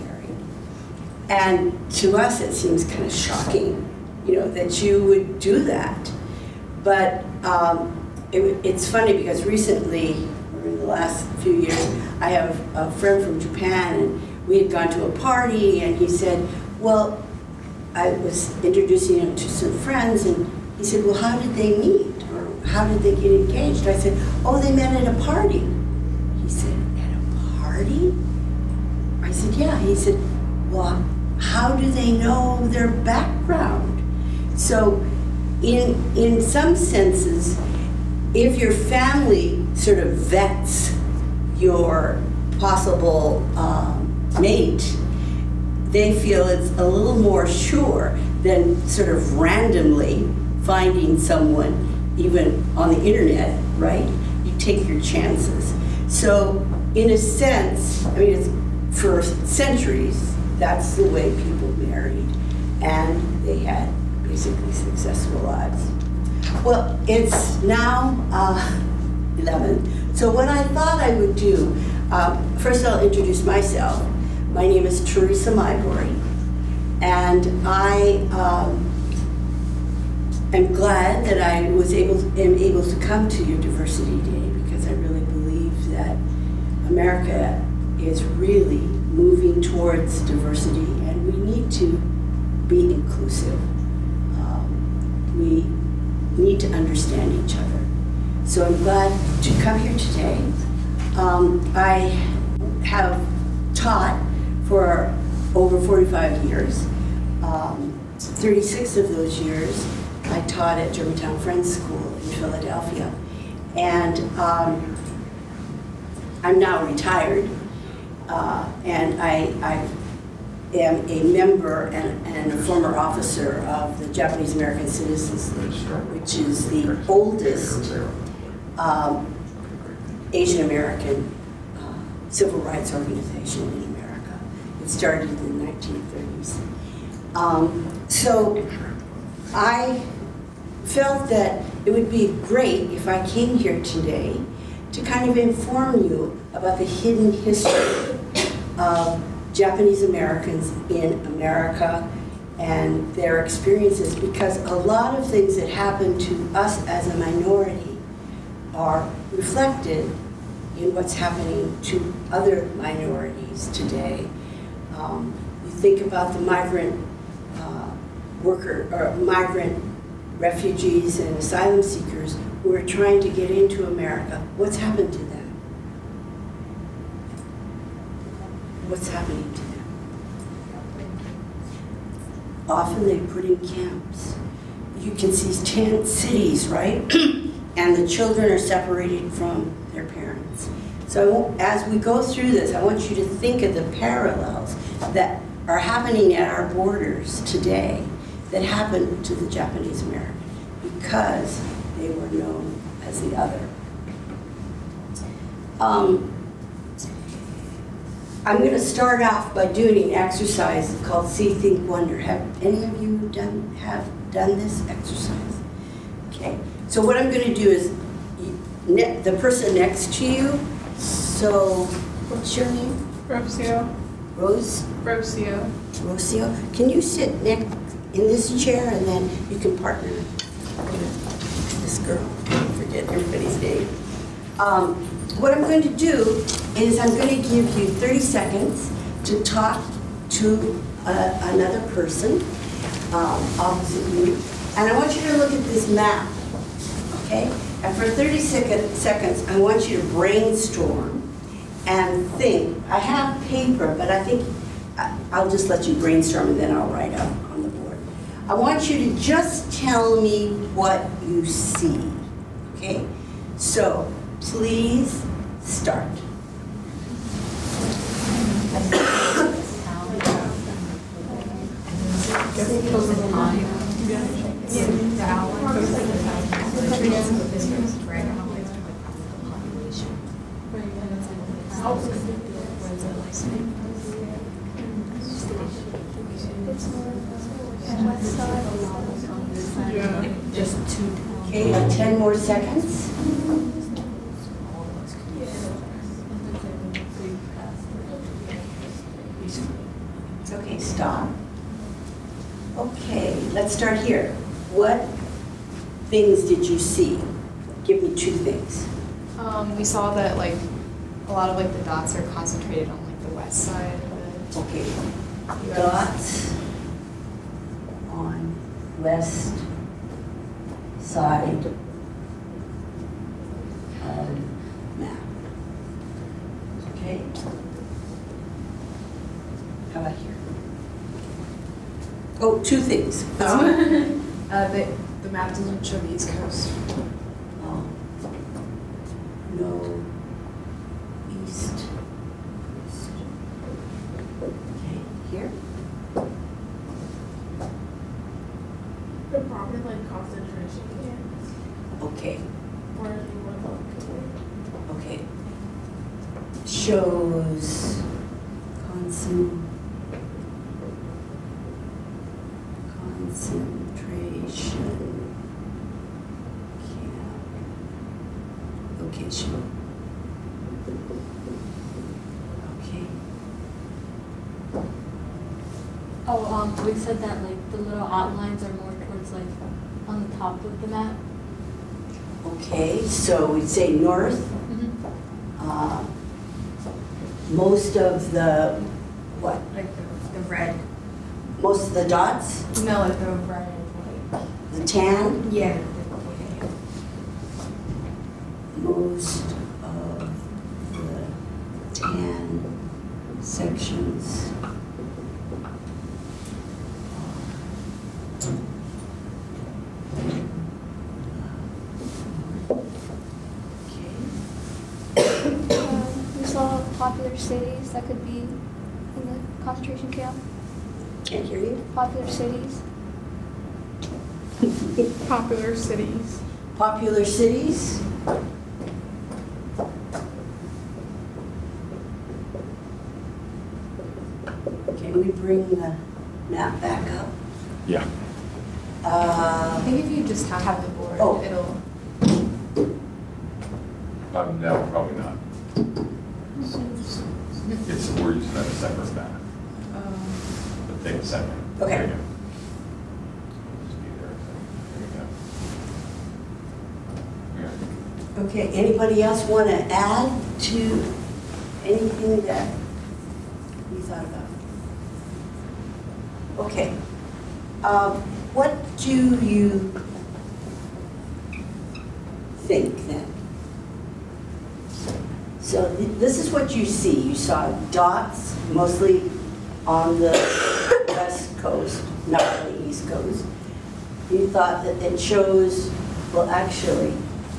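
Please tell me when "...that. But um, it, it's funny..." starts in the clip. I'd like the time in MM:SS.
00:05.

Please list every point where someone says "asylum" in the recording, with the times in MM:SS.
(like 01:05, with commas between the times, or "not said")
02:51.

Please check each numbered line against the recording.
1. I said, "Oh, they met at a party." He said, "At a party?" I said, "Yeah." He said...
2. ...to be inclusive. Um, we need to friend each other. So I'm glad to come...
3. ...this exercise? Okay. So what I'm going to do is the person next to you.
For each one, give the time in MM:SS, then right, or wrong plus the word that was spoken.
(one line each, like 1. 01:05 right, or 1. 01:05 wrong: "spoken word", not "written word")
1. 00:23 right
2. 01:31 wrong: "understand", not "friend"
3. 03:34 right.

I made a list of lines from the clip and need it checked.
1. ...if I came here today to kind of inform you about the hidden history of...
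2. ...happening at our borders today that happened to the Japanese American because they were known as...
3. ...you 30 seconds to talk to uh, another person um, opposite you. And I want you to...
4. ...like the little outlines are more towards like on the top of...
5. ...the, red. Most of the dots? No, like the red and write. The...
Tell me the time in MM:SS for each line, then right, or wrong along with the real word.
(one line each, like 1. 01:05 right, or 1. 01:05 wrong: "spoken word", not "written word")
1. 02:22 right
2. 03:15 right
3. 03:57 right
4. 06:17 right
5. 06:30 wrong: "white", not "write".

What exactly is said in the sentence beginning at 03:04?
You can see tent cities, right?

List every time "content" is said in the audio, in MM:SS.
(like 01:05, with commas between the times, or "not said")
not said.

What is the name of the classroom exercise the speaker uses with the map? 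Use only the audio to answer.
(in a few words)
See, Think, Wonder.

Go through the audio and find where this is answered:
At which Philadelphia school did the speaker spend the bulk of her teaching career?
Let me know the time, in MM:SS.
01:50.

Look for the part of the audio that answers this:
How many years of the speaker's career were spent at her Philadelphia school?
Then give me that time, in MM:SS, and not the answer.
01:48.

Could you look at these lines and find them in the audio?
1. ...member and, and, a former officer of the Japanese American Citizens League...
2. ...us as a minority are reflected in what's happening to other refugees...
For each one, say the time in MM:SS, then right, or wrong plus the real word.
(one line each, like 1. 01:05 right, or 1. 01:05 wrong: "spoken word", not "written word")
1. 02:01 right
2. 02:36 wrong: "minorities", not "refugees".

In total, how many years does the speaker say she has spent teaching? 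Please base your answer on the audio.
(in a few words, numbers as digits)
Over 45 years.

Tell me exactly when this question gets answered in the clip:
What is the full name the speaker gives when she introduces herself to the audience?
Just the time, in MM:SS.
01:15.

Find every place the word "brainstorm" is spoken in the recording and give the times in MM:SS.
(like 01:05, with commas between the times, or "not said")
04:10, 04:15.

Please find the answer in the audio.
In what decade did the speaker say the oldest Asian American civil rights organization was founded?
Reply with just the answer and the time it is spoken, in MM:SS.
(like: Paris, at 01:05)
1930s, at 02:15.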